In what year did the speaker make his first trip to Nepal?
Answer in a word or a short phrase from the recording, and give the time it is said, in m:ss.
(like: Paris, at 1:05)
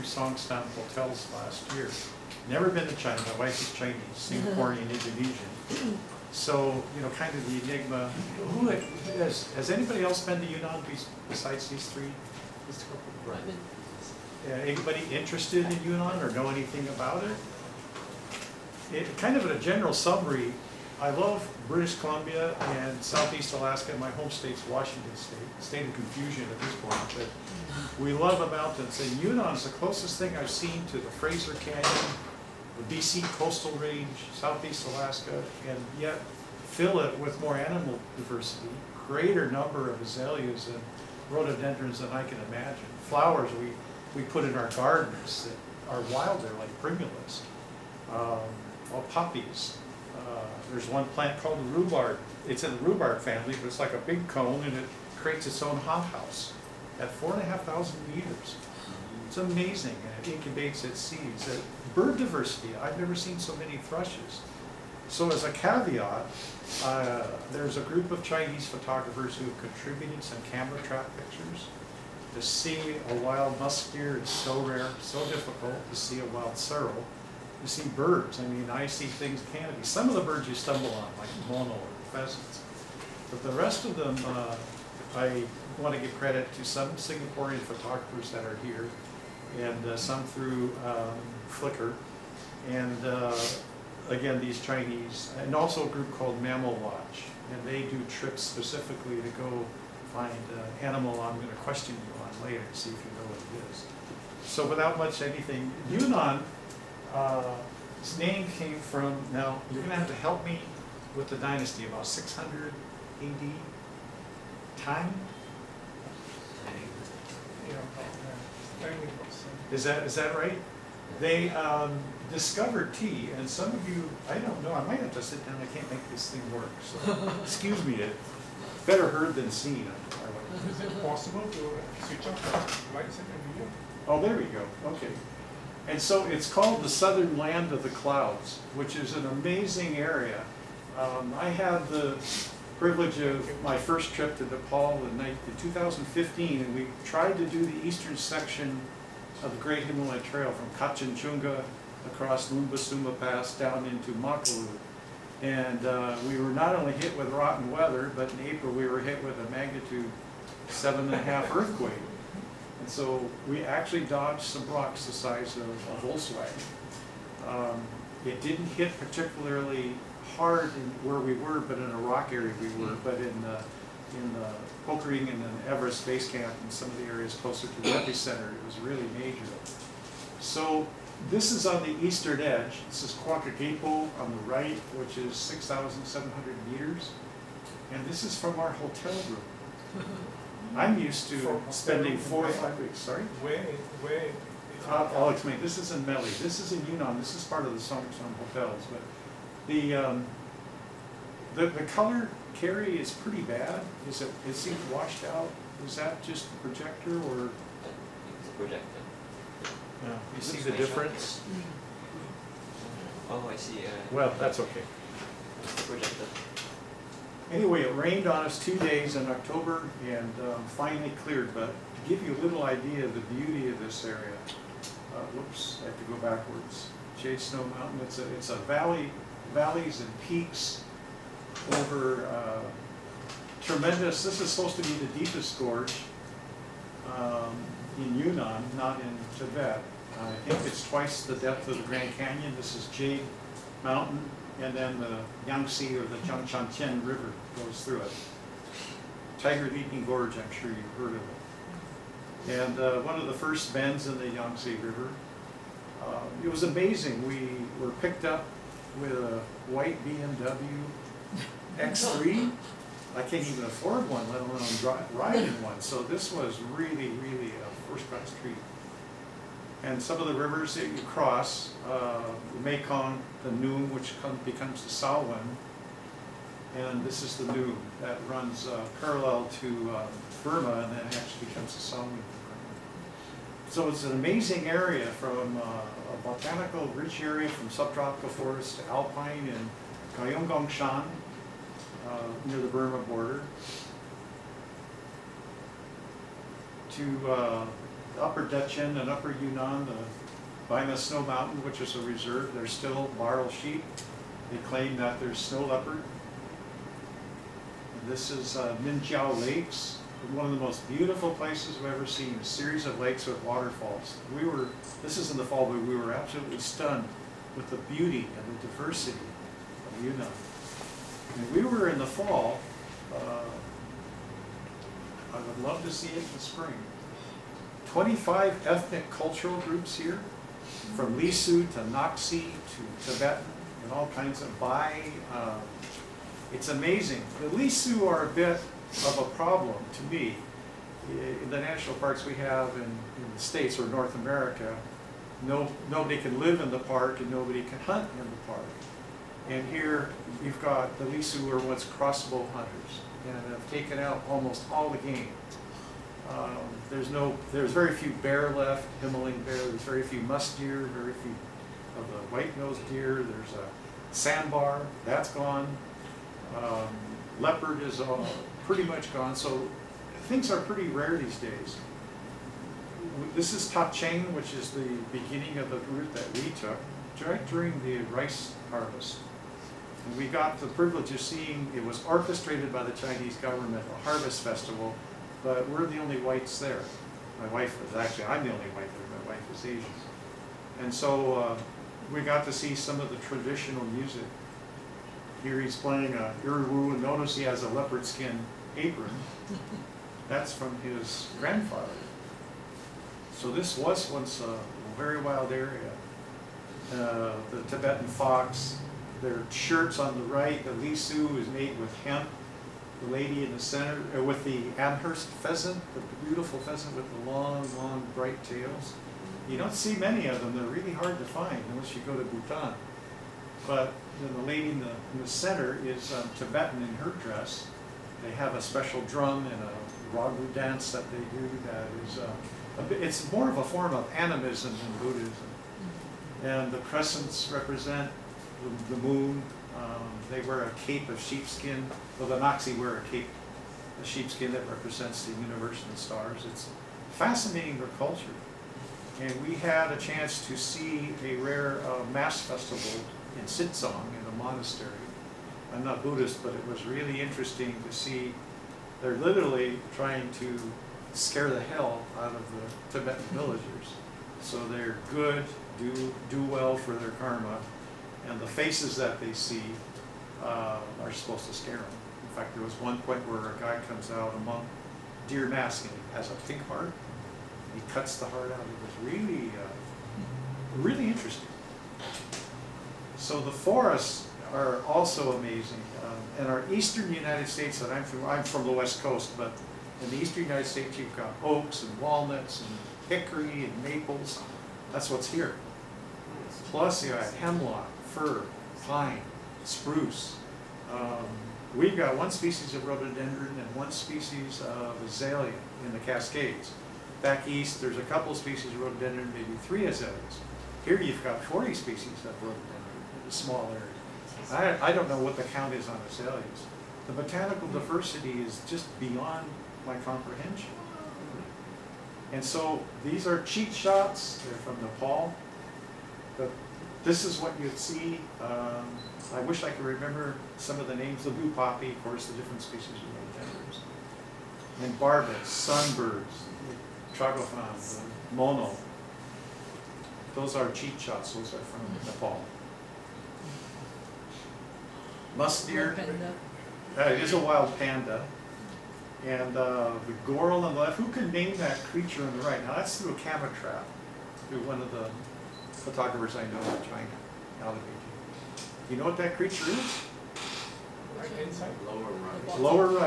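2015, at 2:25.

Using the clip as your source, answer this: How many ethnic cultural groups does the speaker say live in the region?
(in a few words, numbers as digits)
25.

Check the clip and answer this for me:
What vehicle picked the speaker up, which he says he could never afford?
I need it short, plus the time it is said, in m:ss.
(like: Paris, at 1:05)
white BMW X3, at 4:19.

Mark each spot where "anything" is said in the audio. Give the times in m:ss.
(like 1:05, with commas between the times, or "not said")
0:16, 1:45.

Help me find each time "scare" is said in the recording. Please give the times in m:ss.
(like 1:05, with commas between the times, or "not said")
7:41, 7:51.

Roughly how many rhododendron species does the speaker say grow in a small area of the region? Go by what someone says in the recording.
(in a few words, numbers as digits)
40.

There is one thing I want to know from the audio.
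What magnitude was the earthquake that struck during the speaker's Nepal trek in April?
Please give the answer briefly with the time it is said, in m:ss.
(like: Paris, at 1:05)
7.5, at 2:40.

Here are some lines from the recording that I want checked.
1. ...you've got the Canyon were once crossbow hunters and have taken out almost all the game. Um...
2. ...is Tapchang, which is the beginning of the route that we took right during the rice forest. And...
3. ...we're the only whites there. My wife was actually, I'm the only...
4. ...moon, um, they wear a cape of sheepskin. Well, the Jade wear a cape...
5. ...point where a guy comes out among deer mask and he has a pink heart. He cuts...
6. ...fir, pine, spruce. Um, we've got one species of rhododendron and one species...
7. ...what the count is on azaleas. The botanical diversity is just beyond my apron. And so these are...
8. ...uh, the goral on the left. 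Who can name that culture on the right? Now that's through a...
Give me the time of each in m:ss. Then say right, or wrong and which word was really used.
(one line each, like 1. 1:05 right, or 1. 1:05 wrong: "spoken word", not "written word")
1. 5:50 wrong: "Lisu", not "Canyon"
2. 6:13 wrong: "harvest", not "forest"
3. 6:25 right
4. 7:19 wrong: "Naxi", not "Jade"
5. 7:52 right
6. 8:18 right
7. 8:35 wrong: "comprehension", not "apron"
8. 9:09 wrong: "creature", not "culture".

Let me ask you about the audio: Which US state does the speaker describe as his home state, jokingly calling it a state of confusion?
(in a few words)
Washington State.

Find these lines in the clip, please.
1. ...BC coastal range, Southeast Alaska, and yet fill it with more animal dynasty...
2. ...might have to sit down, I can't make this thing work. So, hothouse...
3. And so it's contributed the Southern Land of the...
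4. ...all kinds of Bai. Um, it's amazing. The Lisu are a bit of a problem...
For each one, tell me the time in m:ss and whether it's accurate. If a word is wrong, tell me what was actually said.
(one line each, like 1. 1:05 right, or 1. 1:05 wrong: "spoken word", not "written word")
1. 0:32 wrong: "diversity", not "dynasty"
2. 2:04 wrong: "excuse", not "hothouse"
3. 2:15 wrong: "called", not "contributed"
4. 5:33 right.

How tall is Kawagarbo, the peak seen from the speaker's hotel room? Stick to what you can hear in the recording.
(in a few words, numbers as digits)
6,700 meters.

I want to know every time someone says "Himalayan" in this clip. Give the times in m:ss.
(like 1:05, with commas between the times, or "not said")
2:29, 5:59.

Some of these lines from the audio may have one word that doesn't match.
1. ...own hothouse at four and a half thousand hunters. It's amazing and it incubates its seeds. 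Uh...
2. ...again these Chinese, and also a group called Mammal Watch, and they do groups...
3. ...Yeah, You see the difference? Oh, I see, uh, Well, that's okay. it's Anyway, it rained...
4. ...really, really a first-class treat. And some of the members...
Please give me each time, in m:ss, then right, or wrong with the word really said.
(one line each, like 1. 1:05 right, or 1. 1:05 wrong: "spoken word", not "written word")
1. 0:55 wrong: "meters", not "hunters"
2. 1:34 wrong: "trips", not "groups"
3. 3:28 right
4. 4:26 wrong: "rivers", not "members".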